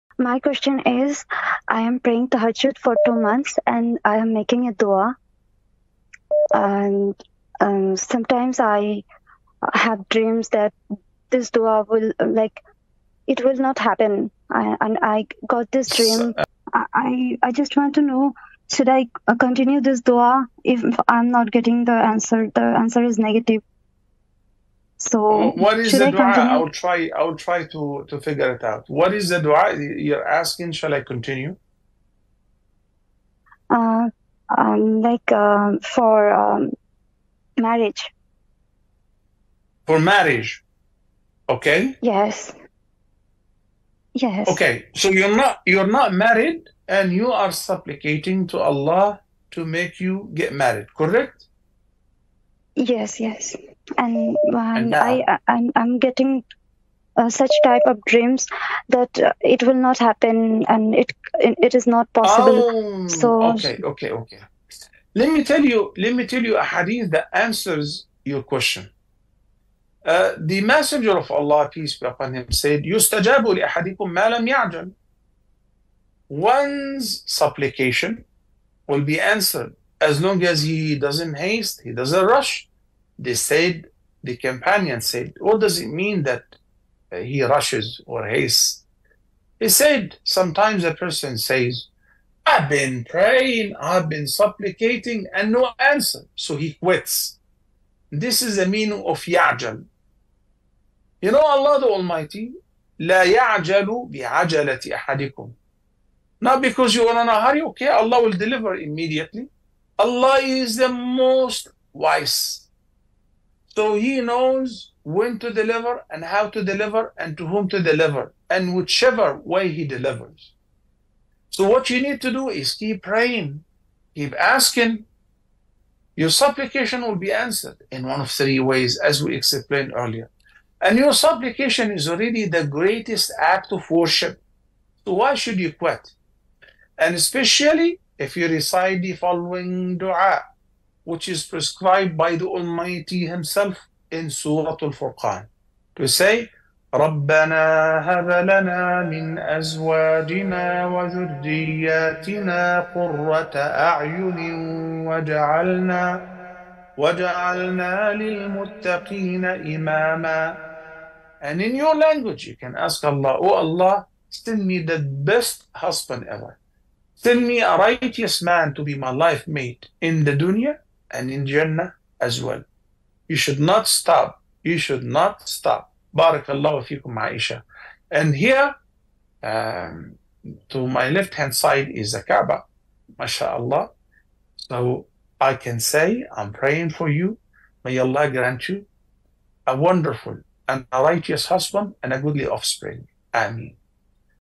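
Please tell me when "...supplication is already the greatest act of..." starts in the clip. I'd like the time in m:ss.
2:11.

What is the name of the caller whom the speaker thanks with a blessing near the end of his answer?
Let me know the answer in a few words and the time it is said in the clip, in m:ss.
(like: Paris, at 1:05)
Aisha, at 2:57.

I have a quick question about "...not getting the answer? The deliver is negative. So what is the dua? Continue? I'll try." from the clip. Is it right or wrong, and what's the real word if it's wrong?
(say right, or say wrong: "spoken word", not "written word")
wrong: "answer", not "deliver".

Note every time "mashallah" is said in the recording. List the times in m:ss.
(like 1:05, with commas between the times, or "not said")
3:03.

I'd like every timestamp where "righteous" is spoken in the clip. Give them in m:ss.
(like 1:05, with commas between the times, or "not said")
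2:47, 3:11.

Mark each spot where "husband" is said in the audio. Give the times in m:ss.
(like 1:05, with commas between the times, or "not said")
2:45, 3:11.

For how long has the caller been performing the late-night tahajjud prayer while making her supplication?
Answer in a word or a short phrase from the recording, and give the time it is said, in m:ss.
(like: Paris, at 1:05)
2 months, at 0:03.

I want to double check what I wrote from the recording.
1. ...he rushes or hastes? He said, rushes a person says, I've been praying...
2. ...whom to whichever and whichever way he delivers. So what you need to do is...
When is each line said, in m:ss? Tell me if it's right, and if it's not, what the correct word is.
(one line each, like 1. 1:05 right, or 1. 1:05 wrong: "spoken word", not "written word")
1. 1:27 wrong: "sometimes", not "rushes"
2. 1:57 wrong: "deliver", not "whichever".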